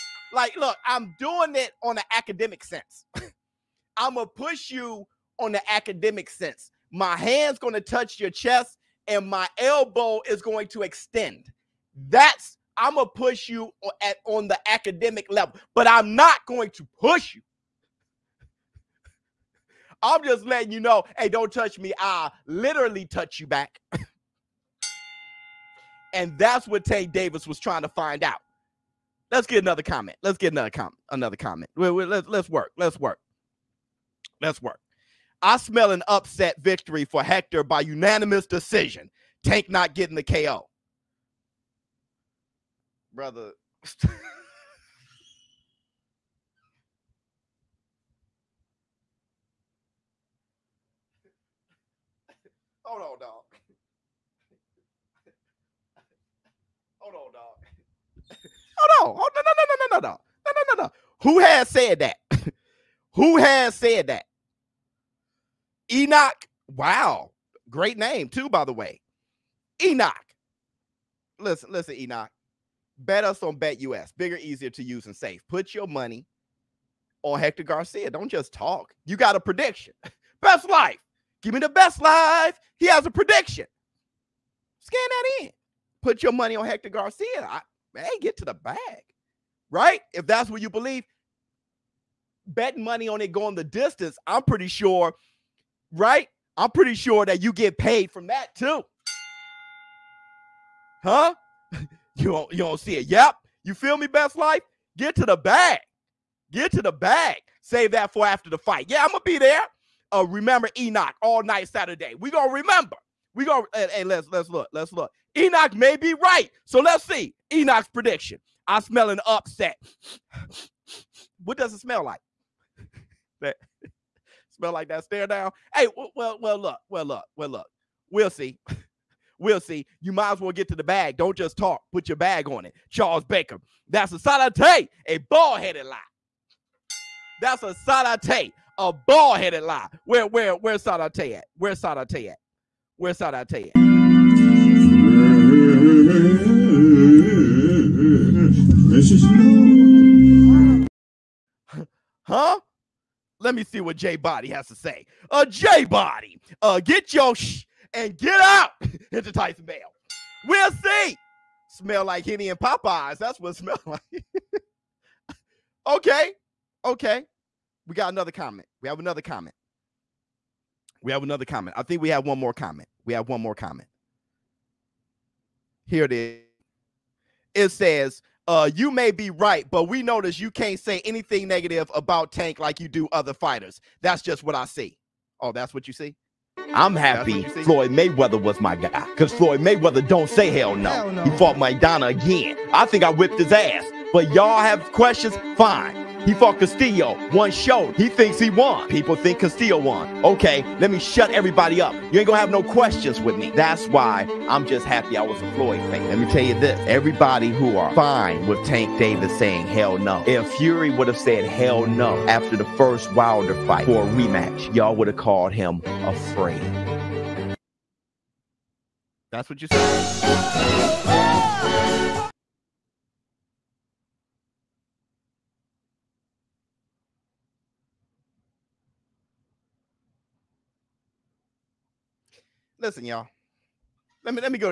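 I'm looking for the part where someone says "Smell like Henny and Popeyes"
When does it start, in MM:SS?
02:41.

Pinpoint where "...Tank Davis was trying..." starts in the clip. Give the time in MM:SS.
00:26.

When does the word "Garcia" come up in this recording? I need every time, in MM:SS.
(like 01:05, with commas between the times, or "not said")
01:17, 01:26.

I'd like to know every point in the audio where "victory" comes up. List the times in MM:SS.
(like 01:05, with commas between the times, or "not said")
00:36.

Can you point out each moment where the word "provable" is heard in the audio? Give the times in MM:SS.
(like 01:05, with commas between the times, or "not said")
not said.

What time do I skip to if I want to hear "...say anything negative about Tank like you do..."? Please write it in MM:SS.
03:00.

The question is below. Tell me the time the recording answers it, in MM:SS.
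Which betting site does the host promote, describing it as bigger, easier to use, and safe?
01:13.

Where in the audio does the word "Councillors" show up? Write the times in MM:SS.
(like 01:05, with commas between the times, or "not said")
not said.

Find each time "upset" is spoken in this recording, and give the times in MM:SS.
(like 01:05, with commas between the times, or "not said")
00:36, 01:59.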